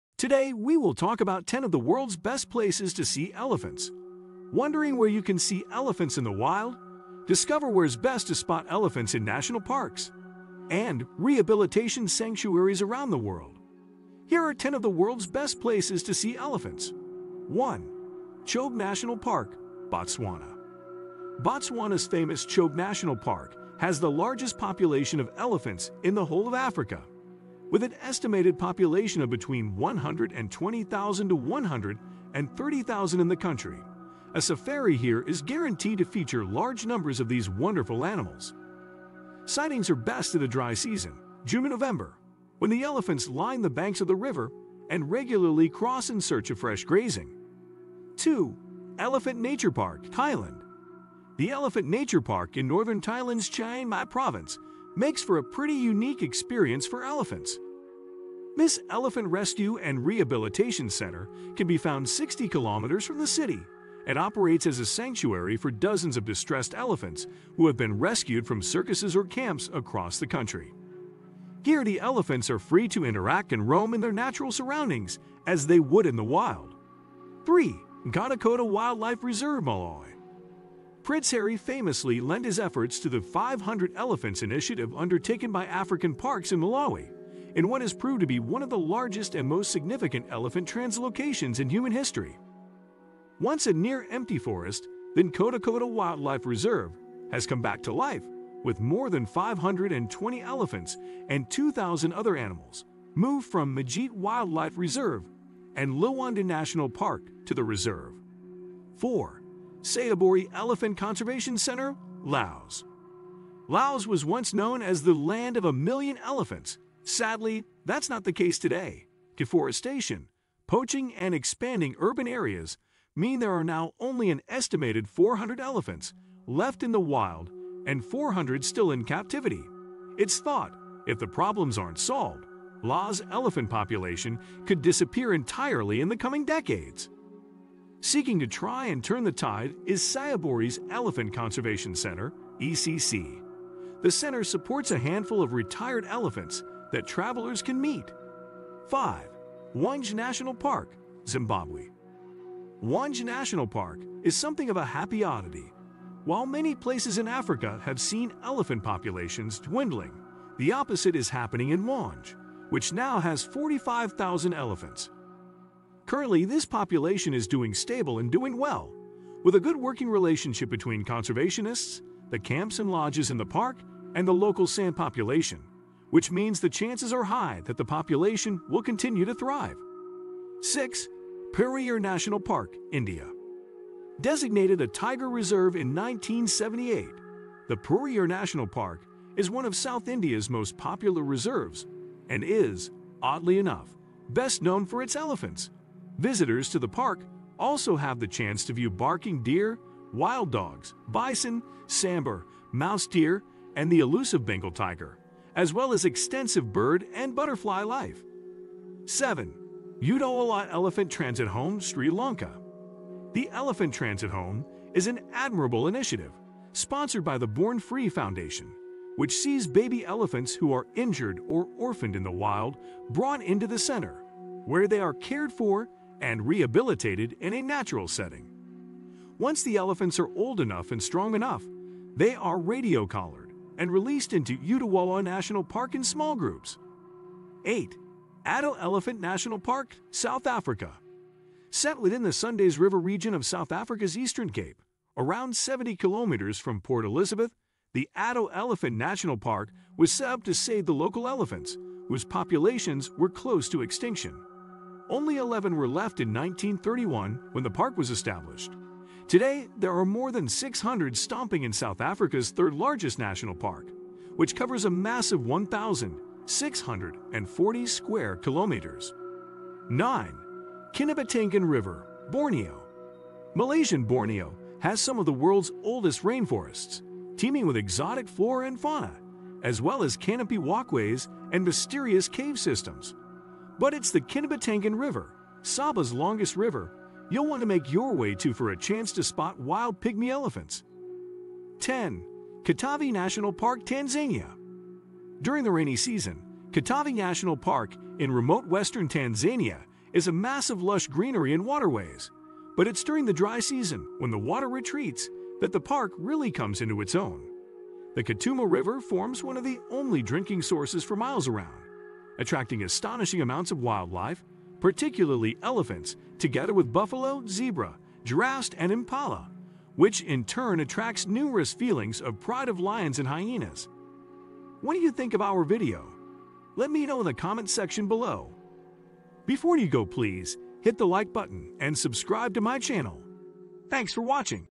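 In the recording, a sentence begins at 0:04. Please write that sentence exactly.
Wondering where you can see elephants in the wild?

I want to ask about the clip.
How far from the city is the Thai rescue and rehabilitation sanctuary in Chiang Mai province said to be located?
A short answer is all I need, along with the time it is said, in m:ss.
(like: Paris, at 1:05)
60 kilometers, at 1:02.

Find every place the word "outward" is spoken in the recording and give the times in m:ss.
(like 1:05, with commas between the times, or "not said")
not said.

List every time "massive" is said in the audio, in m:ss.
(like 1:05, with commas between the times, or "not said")
4:24, 5:00.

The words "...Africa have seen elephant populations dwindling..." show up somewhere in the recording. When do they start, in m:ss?
2:37.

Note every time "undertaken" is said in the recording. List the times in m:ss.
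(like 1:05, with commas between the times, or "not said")
1:24.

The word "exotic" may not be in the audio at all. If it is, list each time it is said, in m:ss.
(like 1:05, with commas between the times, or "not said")
4:37.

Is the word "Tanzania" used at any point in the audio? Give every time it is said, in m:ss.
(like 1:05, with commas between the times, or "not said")
4:53, 4:59.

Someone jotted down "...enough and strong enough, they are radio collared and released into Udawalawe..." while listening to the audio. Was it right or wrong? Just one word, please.
right.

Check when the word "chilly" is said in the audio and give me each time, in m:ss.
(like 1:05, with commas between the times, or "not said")
not said.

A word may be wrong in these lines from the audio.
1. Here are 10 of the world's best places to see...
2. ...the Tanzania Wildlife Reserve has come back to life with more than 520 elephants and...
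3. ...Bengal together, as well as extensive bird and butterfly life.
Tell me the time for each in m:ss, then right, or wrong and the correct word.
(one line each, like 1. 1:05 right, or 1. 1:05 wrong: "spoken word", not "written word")
1. 0:14 right
2. 1:35 wrong: "Nkhotakota", not "Tanzania"
3. 3:24 wrong: "tiger", not "together".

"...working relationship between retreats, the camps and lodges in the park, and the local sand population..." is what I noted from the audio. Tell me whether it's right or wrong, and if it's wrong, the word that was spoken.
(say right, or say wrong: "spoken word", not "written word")
wrong: "conservationists", not "retreats".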